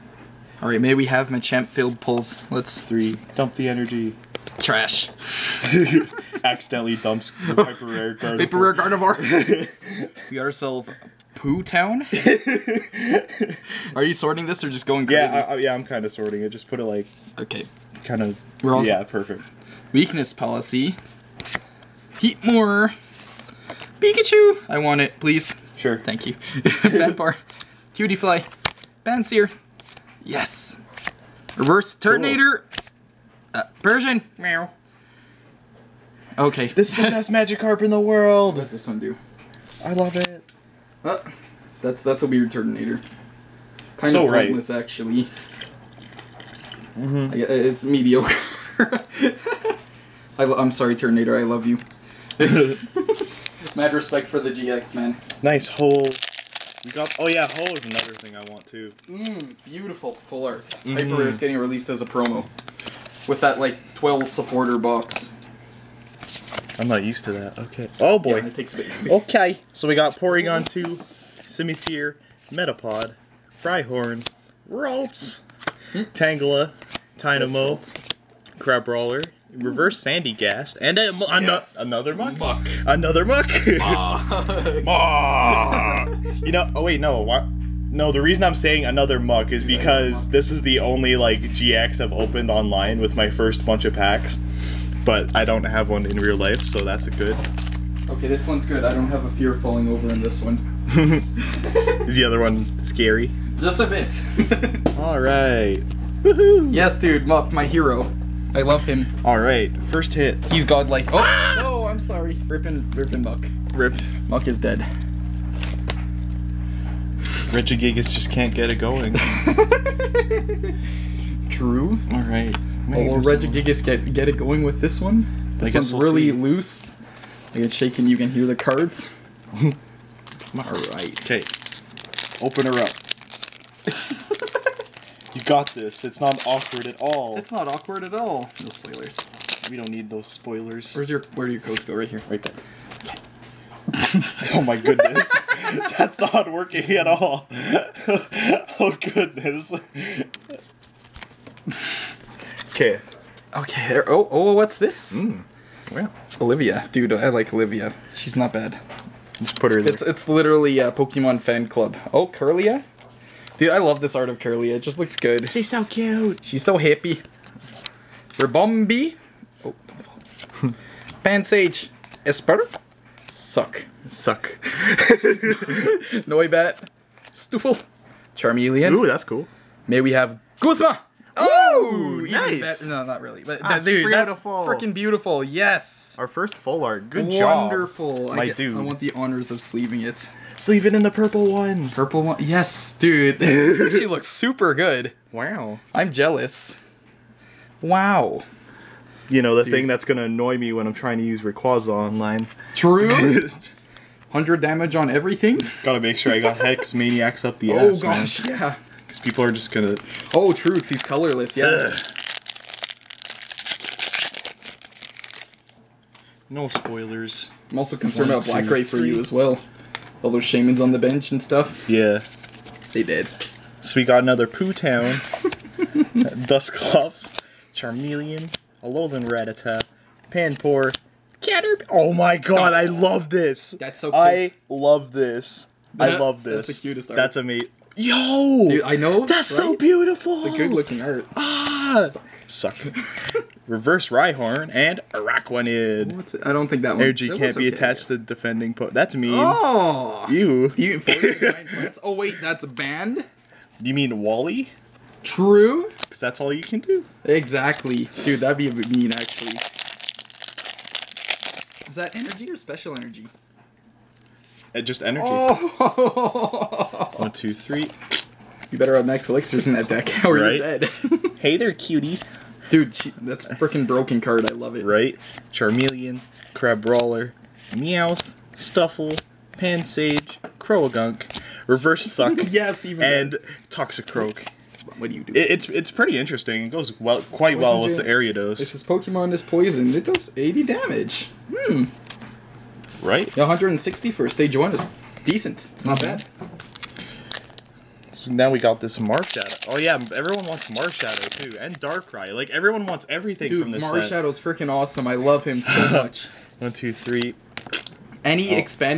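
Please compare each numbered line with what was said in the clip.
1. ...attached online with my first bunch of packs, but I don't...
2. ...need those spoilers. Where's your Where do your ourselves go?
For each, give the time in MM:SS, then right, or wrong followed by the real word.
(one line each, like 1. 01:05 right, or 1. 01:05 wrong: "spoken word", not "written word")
1. 01:32 wrong: "opened", not "attached"
2. 02:19 wrong: "codes", not "ourselves".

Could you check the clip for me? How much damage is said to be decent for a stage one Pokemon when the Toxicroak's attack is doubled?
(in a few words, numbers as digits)
160.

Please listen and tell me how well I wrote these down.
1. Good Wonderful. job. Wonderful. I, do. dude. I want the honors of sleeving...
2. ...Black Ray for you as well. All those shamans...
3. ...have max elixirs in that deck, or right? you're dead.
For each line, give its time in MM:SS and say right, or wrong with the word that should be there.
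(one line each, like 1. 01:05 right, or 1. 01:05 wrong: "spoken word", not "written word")
1. 03:07 right
2. 03:38 right
3. 04:28 right.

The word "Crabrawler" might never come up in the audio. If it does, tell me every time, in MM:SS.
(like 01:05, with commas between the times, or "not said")
01:18, 04:36.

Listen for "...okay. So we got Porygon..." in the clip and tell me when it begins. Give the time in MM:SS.
01:09.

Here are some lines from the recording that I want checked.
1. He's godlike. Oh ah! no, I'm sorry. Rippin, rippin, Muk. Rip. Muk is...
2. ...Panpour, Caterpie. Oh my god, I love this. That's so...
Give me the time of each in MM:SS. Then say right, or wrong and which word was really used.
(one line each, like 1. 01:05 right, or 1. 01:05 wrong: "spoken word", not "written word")
1. 01:50 right
2. 03:50 right.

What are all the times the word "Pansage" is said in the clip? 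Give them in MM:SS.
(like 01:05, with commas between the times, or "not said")
02:51, 04:39.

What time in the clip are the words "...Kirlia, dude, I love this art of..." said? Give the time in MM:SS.
02:42.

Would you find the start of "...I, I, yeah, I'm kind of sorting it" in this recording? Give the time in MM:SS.
00:15.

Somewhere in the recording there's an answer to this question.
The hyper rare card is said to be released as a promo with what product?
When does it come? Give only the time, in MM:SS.
01:03.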